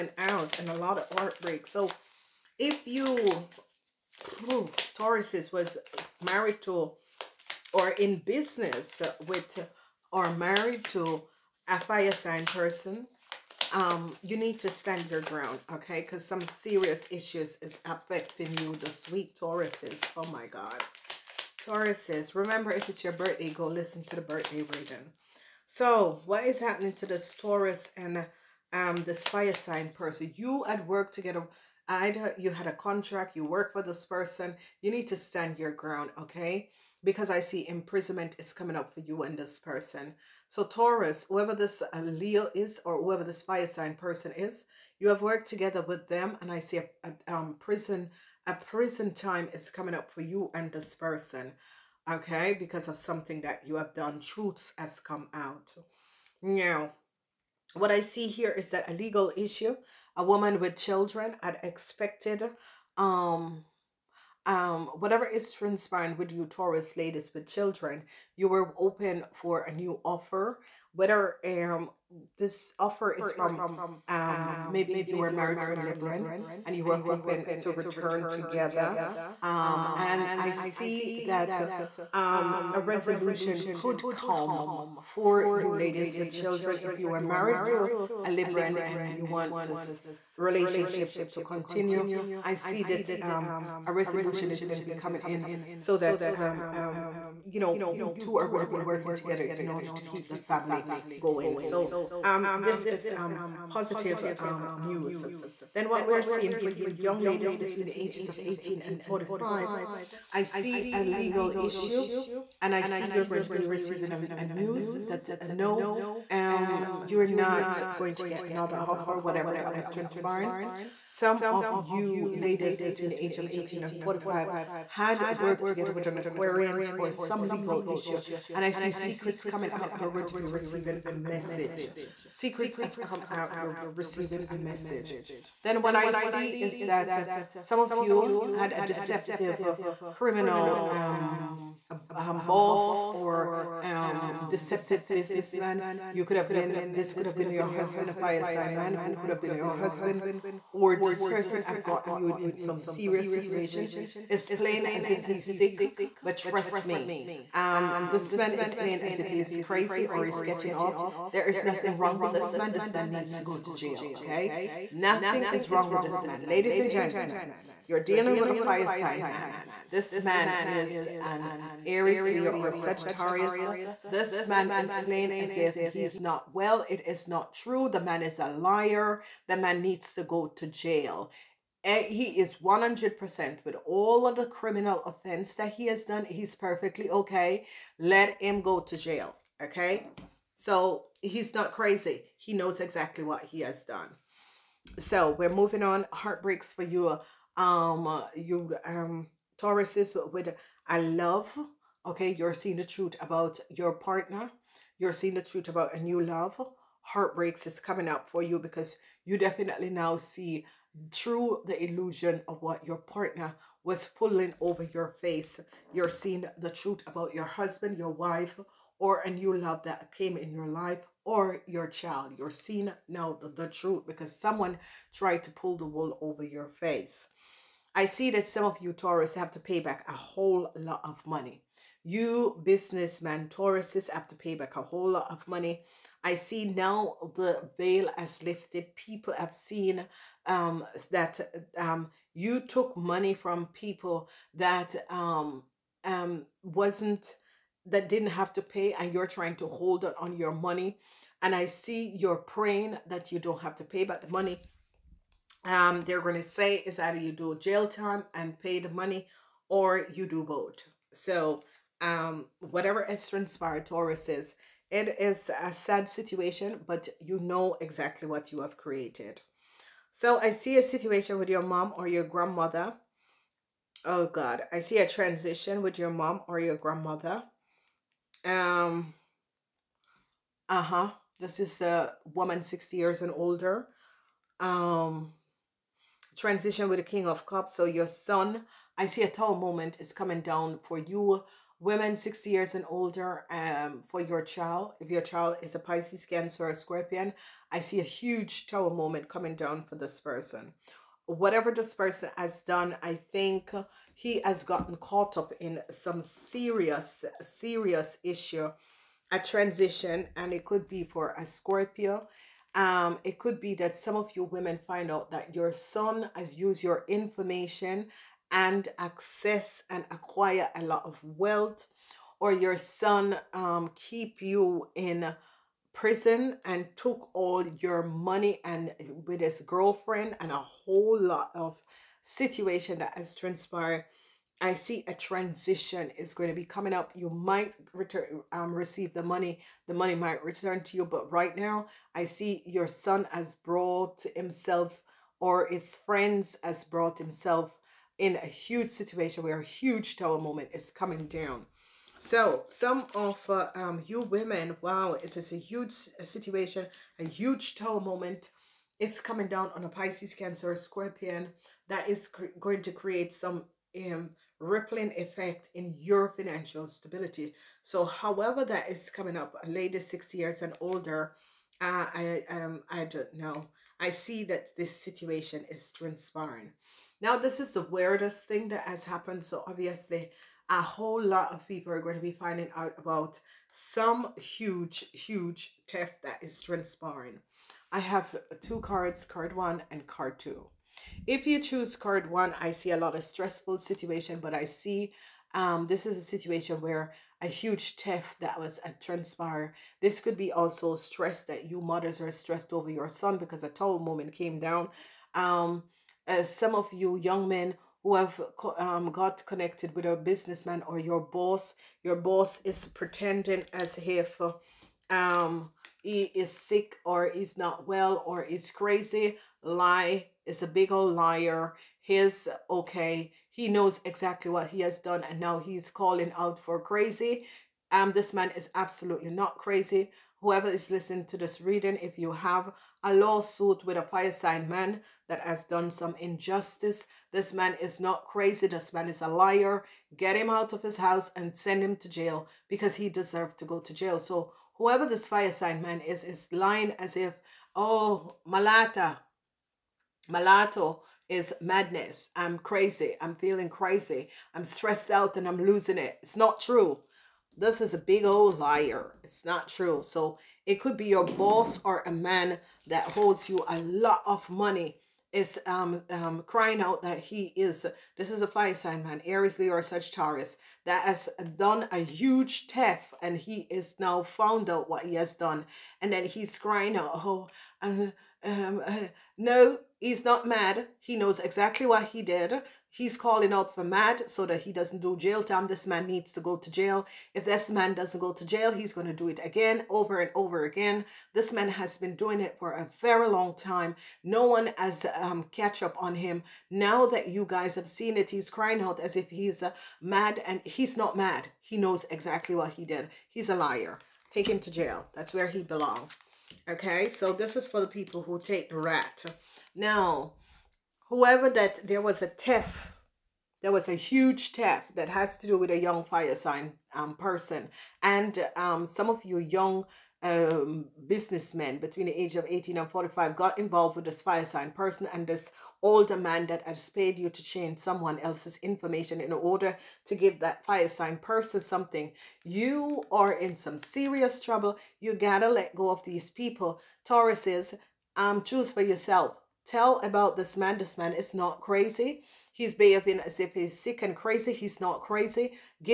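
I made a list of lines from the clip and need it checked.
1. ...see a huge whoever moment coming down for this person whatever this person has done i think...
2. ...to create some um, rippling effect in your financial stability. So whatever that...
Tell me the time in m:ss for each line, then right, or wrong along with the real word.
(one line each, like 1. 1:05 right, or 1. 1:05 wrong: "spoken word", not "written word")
1. 4:57 wrong: "tower", not "whoever"
2. 6:02 wrong: "however", not "whatever".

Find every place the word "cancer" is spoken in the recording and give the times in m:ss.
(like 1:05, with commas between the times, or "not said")
4:56, 6:00.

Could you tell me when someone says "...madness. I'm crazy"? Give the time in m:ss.
7:31.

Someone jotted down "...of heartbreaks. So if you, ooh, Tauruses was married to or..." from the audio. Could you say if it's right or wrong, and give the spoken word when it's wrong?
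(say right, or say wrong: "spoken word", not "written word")
right.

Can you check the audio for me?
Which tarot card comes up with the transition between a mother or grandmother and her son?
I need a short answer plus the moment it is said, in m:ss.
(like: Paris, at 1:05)
King of Cups, at 4:47.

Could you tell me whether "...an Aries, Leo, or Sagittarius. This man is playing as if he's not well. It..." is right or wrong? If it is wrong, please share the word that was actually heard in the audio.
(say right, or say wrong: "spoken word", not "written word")
right.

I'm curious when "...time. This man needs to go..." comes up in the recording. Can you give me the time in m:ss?
8:05.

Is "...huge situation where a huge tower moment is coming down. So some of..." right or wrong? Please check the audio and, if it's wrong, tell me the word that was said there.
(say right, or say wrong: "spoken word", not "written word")
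right.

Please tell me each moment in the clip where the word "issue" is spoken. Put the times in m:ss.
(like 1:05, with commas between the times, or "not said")
0:17, 0:59, 1:51, 2:07, 5:08.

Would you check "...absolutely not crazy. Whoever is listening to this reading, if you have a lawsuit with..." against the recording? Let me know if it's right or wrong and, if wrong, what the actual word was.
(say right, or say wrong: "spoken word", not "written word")
right.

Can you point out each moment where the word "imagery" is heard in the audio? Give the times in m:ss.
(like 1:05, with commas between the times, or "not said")
not said.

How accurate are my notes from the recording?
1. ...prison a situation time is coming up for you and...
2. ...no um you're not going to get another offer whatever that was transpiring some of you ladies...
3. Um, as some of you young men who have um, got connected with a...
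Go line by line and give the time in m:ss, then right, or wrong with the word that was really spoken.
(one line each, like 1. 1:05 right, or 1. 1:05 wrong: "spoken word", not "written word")
1. 0:47 wrong: "prison", not "situation"
2. 1:55 right
3. 6:45 right.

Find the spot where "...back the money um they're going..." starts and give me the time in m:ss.
4:14.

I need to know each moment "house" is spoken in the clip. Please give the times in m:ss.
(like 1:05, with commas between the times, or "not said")
7:20.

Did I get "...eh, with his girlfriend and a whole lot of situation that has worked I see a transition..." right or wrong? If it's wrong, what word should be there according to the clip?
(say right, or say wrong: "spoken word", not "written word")
wrong: "transpired", not "worked".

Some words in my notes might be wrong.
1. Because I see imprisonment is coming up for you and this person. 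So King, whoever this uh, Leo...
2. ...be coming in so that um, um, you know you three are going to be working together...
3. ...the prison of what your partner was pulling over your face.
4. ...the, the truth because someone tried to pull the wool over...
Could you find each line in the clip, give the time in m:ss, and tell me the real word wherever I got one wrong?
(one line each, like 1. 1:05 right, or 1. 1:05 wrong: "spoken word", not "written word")
1. 0:37 wrong: "Taurus", not "King"
2. 1:34 wrong: "two", not "three"
3. 3:31 wrong: "illusion", not "prison"
4. 3:43 right.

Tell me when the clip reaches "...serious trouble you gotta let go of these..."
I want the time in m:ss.
8:53.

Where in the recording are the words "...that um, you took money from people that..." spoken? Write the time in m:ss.
4:01.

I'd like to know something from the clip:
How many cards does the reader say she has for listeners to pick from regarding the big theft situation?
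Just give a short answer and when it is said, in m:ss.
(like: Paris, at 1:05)
2, at 6:28.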